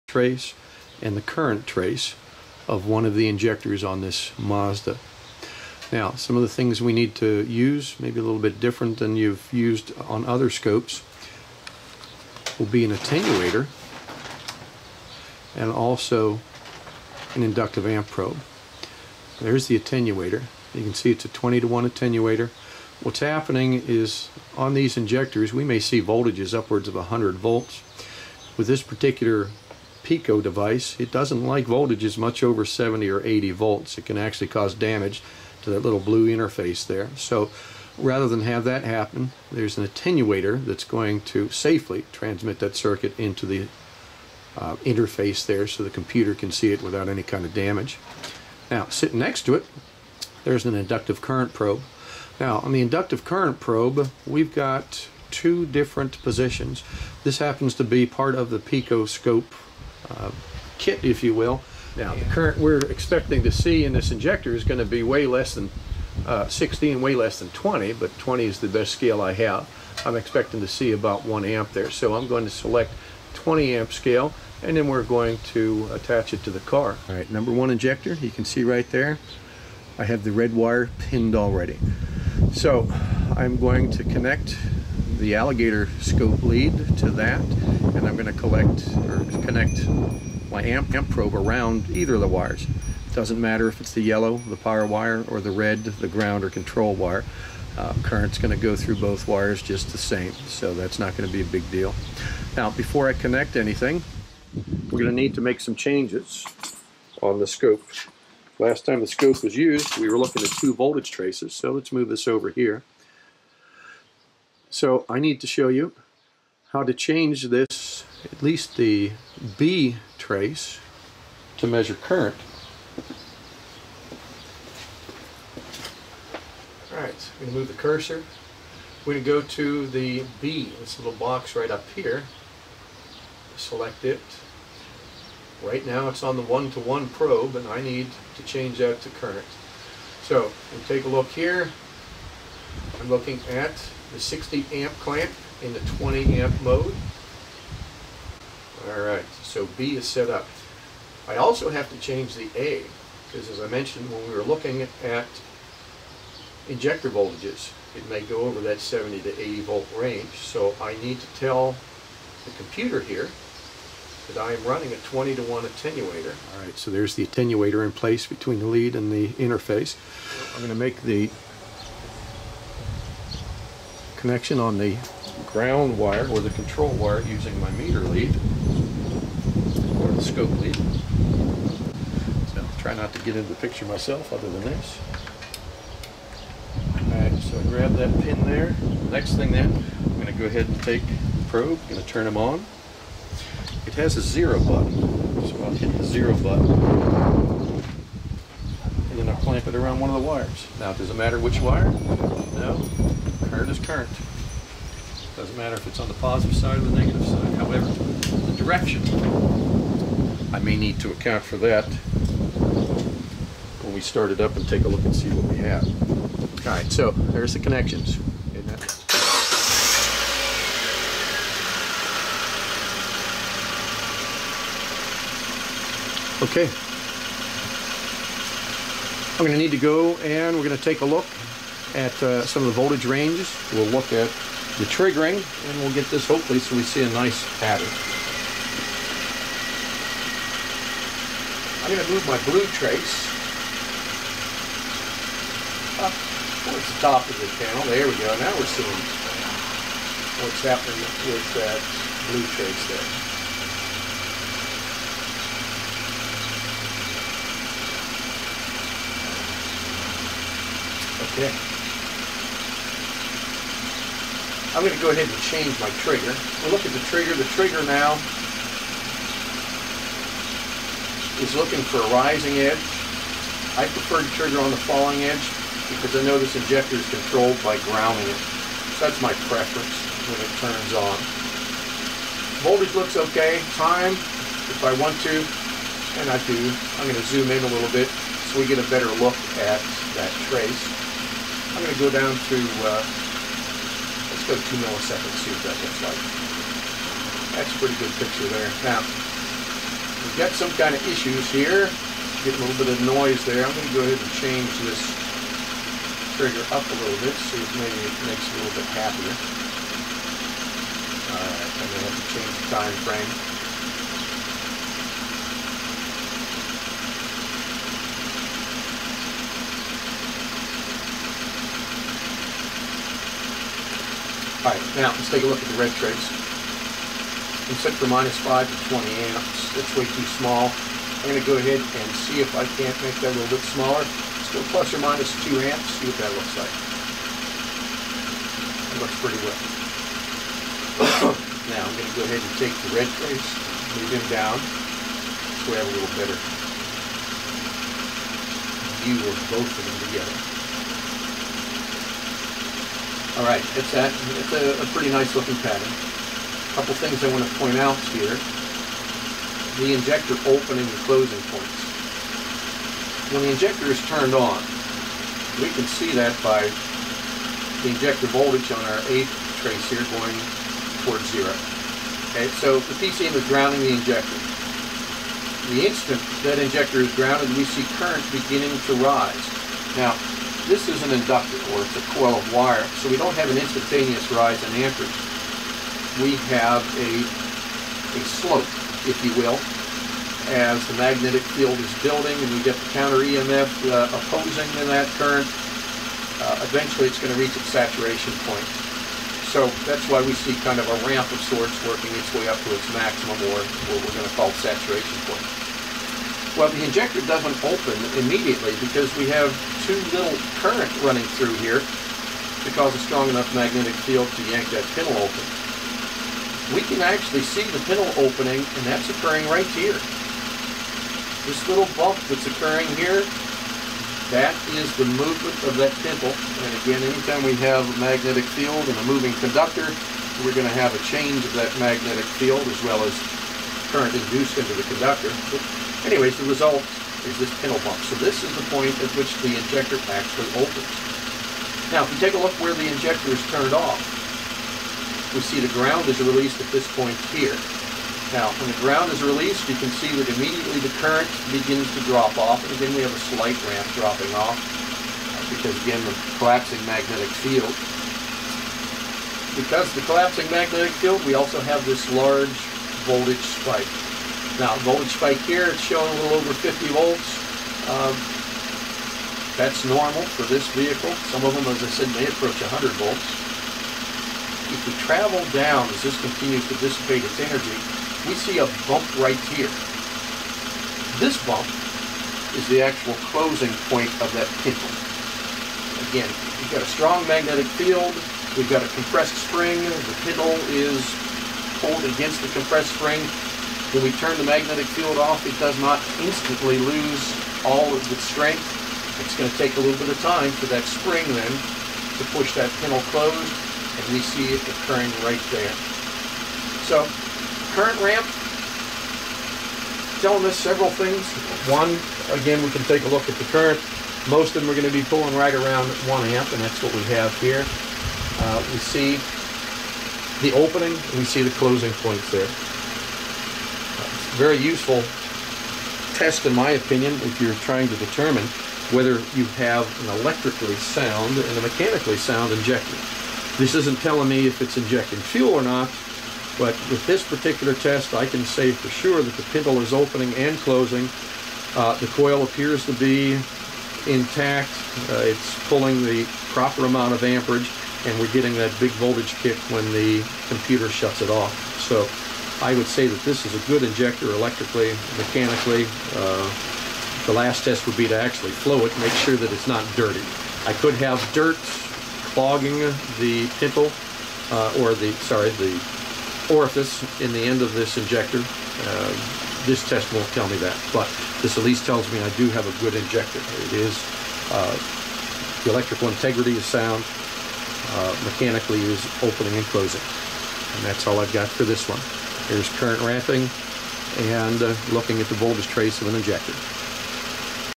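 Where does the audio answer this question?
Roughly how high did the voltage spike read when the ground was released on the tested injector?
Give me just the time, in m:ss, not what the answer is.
7:46.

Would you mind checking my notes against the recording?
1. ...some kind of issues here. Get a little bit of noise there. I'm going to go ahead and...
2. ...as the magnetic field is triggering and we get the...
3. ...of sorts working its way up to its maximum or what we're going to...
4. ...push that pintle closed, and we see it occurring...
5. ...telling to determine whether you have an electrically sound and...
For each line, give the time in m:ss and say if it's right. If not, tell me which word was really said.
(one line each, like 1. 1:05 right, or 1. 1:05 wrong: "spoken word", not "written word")
1. 5:00 right
2. 6:30 wrong: "building", not "triggering"
3. 6:41 right
4. 8:22 right
5. 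8:47 wrong: "trying", not "telling".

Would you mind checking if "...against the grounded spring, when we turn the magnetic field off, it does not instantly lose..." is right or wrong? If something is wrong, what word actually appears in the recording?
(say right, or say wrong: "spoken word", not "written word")
wrong: "compressed", not "grounded".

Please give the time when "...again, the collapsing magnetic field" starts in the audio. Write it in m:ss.
7:35.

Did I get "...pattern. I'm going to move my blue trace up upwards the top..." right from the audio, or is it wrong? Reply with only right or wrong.
wrong.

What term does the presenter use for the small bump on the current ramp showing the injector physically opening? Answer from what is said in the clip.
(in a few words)
Pintle bump.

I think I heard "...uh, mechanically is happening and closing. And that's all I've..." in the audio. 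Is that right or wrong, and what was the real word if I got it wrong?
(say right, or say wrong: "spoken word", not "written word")
wrong: "opening", not "happening".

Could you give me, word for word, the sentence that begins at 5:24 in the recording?
All right, now let's take a look at the red trace.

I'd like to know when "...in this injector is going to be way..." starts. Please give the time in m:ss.
1:03.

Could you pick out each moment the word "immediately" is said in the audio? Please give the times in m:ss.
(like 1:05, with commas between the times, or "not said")
6:48, 7:30.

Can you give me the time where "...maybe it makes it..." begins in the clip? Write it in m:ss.
5:07.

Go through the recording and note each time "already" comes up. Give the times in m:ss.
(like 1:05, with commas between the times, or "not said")
1:21.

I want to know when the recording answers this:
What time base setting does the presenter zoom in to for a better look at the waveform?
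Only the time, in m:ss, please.
4:54.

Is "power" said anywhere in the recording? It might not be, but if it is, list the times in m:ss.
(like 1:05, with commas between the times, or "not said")
1:34.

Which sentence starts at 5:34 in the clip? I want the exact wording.
Still plus or minus 2 amps, see what that looks like.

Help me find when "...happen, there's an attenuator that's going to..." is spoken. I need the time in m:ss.
0:38.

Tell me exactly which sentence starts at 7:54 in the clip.
If we travel down as this continues to dissipate its energy, we see a bump right here.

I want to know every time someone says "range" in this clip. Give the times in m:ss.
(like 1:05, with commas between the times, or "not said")
2:39, 3:53.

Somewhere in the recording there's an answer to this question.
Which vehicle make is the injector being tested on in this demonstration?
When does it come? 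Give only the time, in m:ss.
0:04.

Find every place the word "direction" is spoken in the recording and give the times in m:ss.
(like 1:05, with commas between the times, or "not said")
3:28.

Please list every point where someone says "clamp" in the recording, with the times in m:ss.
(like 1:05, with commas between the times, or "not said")
2:24, 3:19.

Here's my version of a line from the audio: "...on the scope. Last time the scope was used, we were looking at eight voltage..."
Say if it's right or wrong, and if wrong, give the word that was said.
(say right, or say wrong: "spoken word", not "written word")
wrong: "two", not "eight".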